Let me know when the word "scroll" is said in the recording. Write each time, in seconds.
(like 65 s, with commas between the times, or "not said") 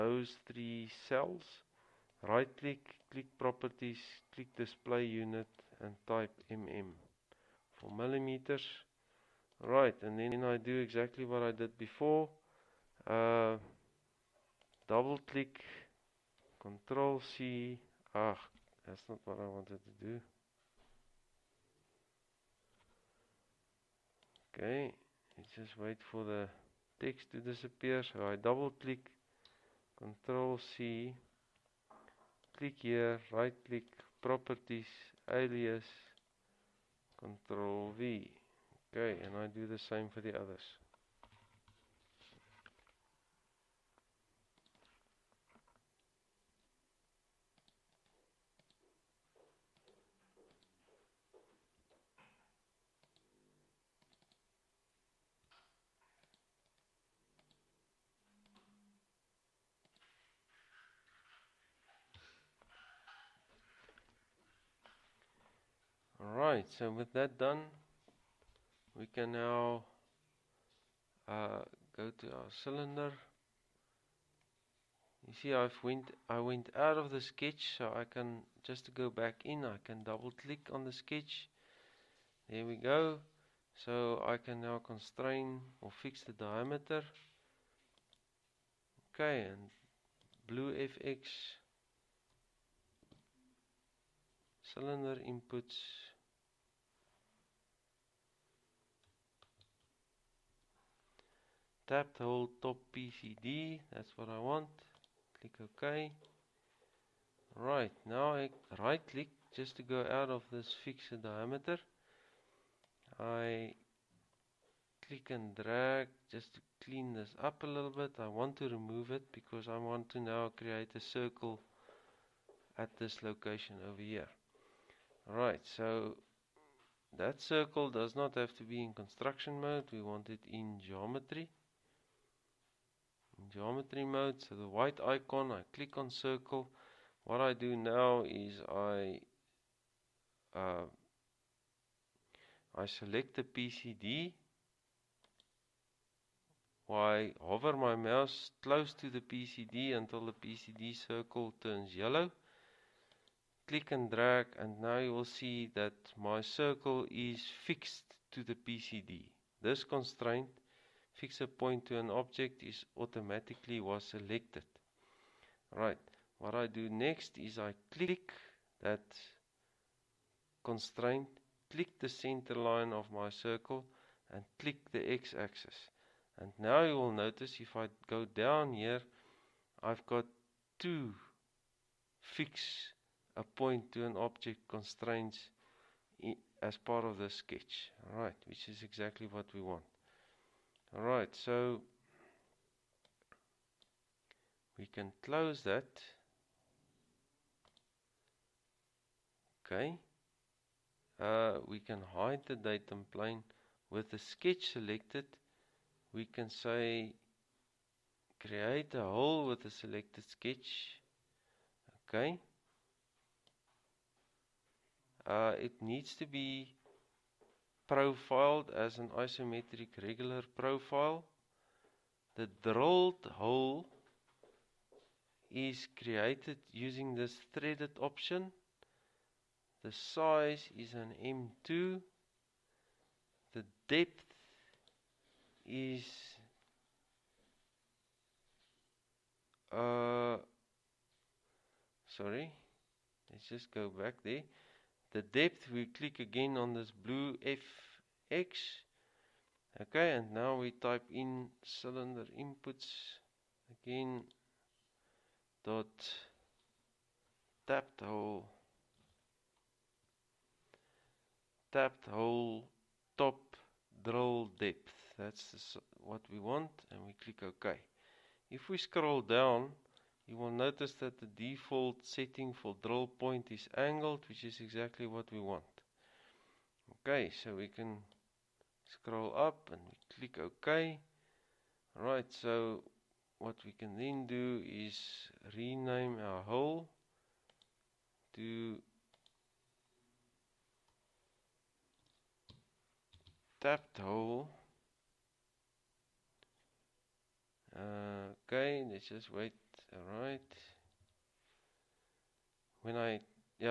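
268 s, 278 s.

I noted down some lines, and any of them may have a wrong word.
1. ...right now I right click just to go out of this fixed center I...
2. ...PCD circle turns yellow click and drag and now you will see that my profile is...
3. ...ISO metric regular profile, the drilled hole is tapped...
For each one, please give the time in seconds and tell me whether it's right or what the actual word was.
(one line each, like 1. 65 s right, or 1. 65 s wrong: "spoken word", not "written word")
1. 107 s wrong: "diameter", not "center"
2. 150 s wrong: "circle", not "profile"
3. 219 s wrong: "created", not "tapped".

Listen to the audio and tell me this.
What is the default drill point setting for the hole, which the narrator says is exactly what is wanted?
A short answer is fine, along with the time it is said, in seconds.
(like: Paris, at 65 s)
angled, at 273 s.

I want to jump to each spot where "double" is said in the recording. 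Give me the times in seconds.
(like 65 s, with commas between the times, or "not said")
14 s, 28 s, 80 s.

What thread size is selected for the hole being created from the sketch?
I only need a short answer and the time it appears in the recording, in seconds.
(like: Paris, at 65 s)
M2, at 231 s.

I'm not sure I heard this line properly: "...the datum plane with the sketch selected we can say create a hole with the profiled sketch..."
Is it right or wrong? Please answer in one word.
wrong.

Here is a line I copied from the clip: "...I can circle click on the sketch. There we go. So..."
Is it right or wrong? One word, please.
wrong.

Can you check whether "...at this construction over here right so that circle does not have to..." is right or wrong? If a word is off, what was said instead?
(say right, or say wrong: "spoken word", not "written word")
wrong: "location", not "construction".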